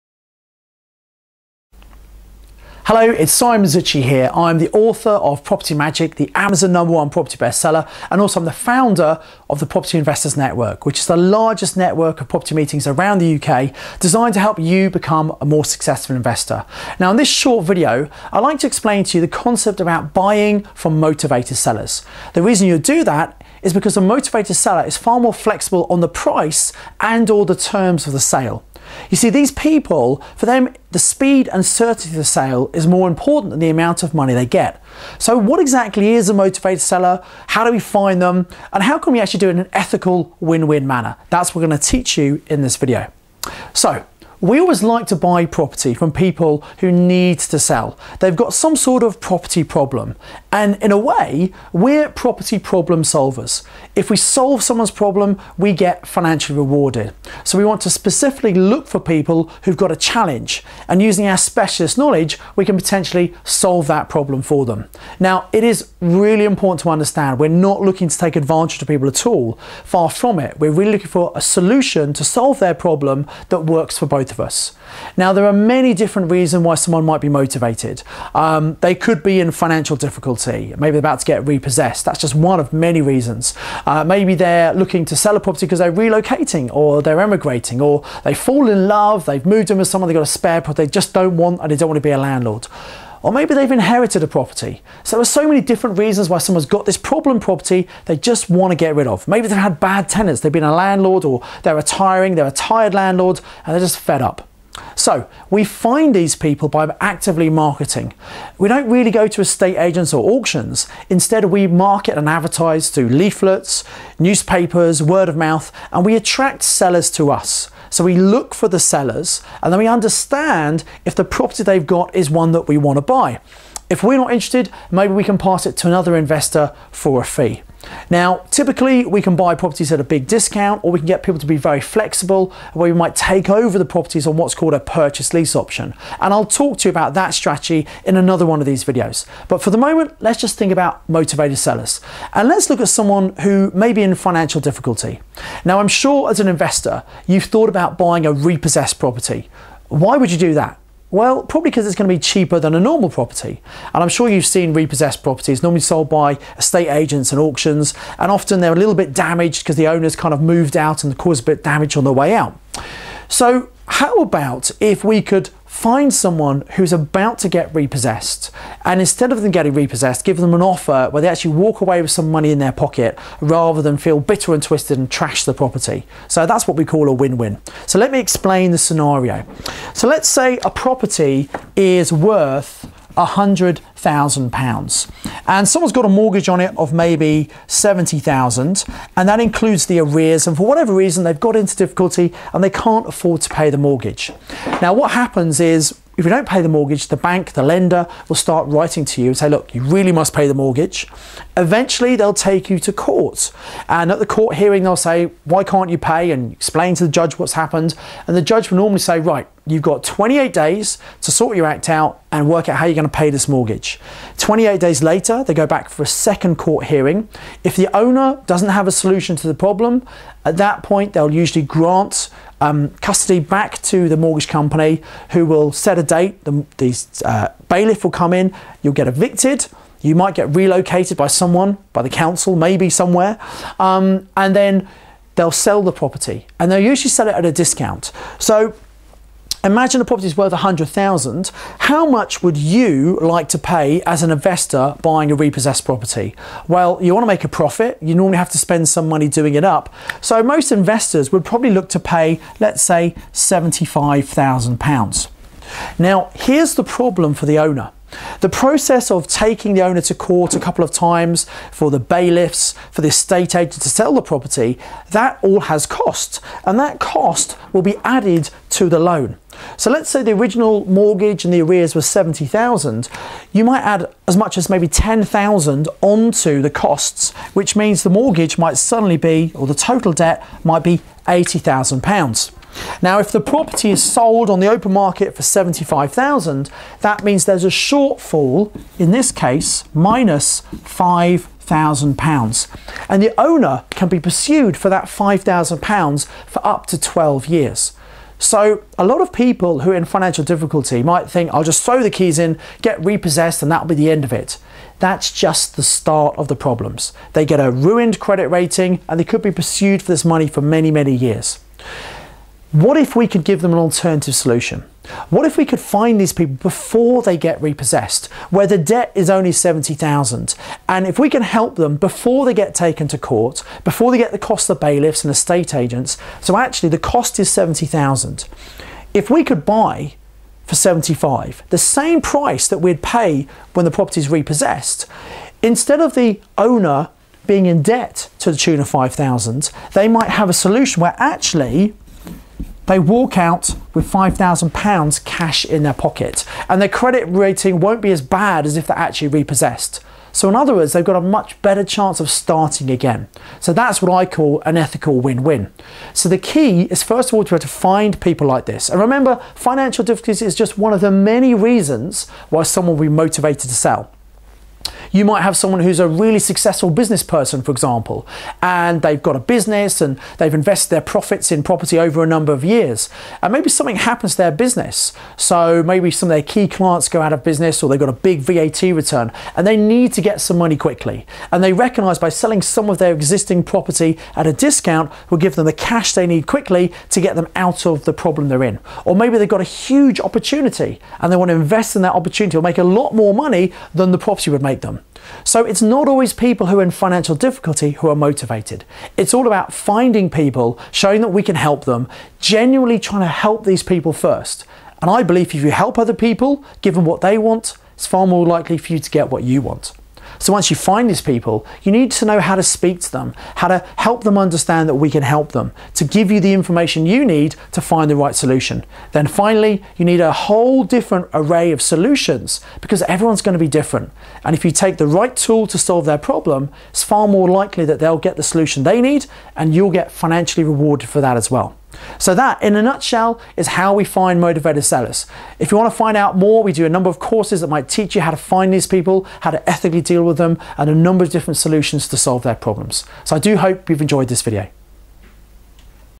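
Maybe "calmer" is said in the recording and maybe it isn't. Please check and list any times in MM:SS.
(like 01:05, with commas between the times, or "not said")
not said.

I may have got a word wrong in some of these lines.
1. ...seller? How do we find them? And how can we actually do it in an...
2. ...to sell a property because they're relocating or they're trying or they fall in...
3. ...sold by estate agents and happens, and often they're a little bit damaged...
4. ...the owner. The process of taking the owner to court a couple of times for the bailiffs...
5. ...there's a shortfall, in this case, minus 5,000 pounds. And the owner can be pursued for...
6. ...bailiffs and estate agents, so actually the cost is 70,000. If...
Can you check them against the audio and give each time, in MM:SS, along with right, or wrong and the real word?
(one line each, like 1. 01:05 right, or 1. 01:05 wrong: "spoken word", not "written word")
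1. 00:36 right
2. 01:25 wrong: "emigrating", not "trying"
3. 02:35 wrong: "auctions", not "happens"
4. 04:17 right
5. 04:47 right
6. 05:24 right.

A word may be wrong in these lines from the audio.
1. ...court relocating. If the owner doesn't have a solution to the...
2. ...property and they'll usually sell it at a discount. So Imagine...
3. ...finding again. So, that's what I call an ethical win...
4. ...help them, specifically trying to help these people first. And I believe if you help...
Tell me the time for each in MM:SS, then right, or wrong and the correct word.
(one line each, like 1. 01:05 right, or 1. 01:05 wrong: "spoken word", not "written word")
1. 03:36 wrong: "hearing", not "relocating"
2. 03:55 right
3. 05:52 wrong: "starting", not "finding"
4. 06:41 wrong: "genuinely", not "specifically".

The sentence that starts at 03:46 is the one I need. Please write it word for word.
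The, the uh, bailiff will come in, you'll get evicted.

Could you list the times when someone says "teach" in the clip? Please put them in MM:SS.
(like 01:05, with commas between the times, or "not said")
00:41, 07:17.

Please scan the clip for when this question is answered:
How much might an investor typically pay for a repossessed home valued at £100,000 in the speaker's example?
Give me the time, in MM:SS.
04:13.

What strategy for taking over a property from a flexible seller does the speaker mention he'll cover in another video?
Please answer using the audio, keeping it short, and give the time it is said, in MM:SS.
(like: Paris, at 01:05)
purchase lease option, at 02:14.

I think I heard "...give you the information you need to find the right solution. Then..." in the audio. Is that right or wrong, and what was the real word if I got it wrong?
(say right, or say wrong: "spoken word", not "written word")
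right.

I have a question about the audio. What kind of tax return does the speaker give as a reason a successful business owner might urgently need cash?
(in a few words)
VAT.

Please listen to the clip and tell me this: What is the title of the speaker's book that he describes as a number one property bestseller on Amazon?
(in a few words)
Property Magic.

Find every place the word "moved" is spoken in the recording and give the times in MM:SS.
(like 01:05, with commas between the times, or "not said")
01:29, 02:40.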